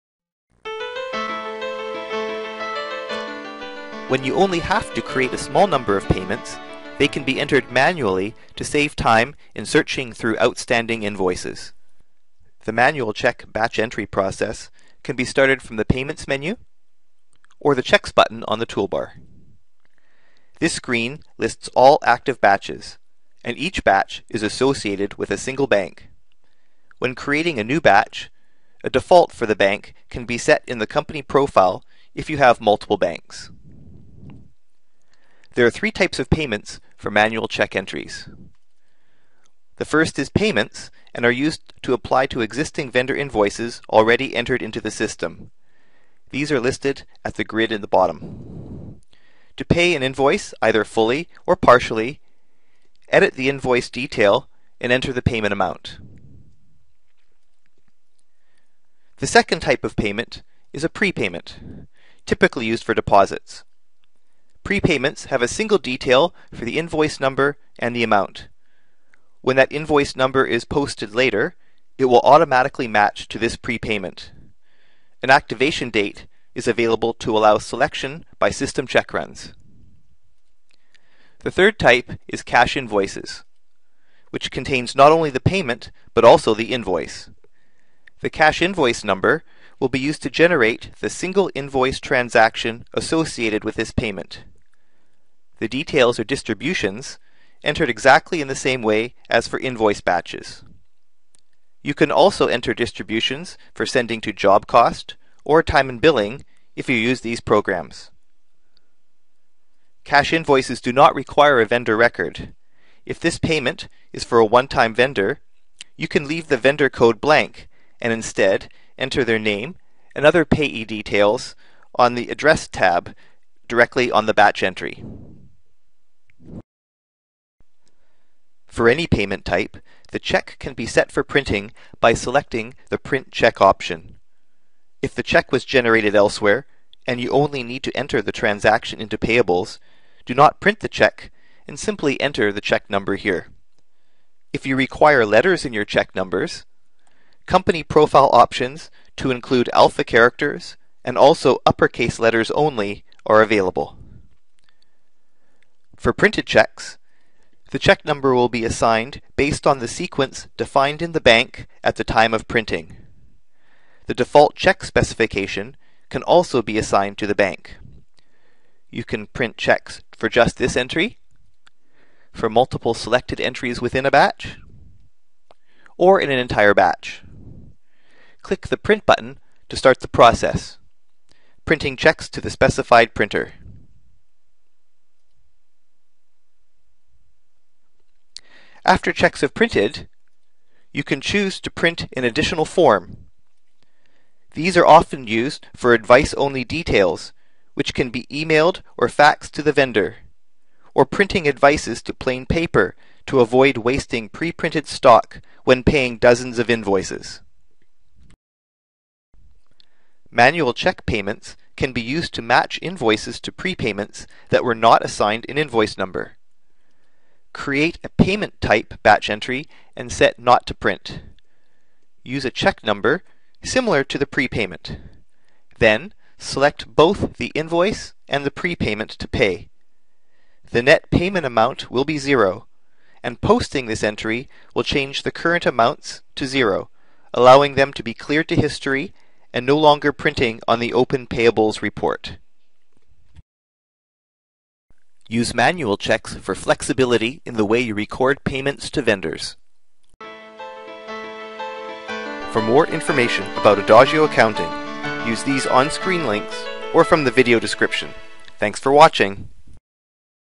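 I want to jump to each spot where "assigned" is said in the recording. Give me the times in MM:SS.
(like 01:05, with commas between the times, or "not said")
02:38, 02:46, 03:35.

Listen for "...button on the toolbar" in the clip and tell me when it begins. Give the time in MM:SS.
00:18.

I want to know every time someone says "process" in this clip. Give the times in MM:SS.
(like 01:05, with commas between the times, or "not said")
00:14, 03:00.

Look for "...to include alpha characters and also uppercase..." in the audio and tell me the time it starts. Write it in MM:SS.
02:29.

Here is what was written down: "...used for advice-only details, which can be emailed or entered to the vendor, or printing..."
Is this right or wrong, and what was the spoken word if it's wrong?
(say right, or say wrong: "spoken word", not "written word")
wrong: "faxed", not "entered".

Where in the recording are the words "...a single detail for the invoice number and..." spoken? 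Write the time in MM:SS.
01:05.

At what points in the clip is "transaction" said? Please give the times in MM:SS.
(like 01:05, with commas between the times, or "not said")
01:31, 02:18.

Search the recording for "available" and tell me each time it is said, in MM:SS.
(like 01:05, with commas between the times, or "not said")
01:16, 02:33.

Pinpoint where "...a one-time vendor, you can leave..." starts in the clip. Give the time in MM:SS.
01:54.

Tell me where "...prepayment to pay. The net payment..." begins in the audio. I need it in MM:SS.
03:48.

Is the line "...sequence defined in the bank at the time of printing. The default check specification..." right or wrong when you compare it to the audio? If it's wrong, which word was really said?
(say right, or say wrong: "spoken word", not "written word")
right.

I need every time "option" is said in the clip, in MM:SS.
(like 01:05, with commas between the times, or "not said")
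02:13, 02:28.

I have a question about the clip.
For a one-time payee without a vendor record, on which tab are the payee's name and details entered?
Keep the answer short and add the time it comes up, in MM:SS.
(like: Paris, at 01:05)
Address tab, at 02:02.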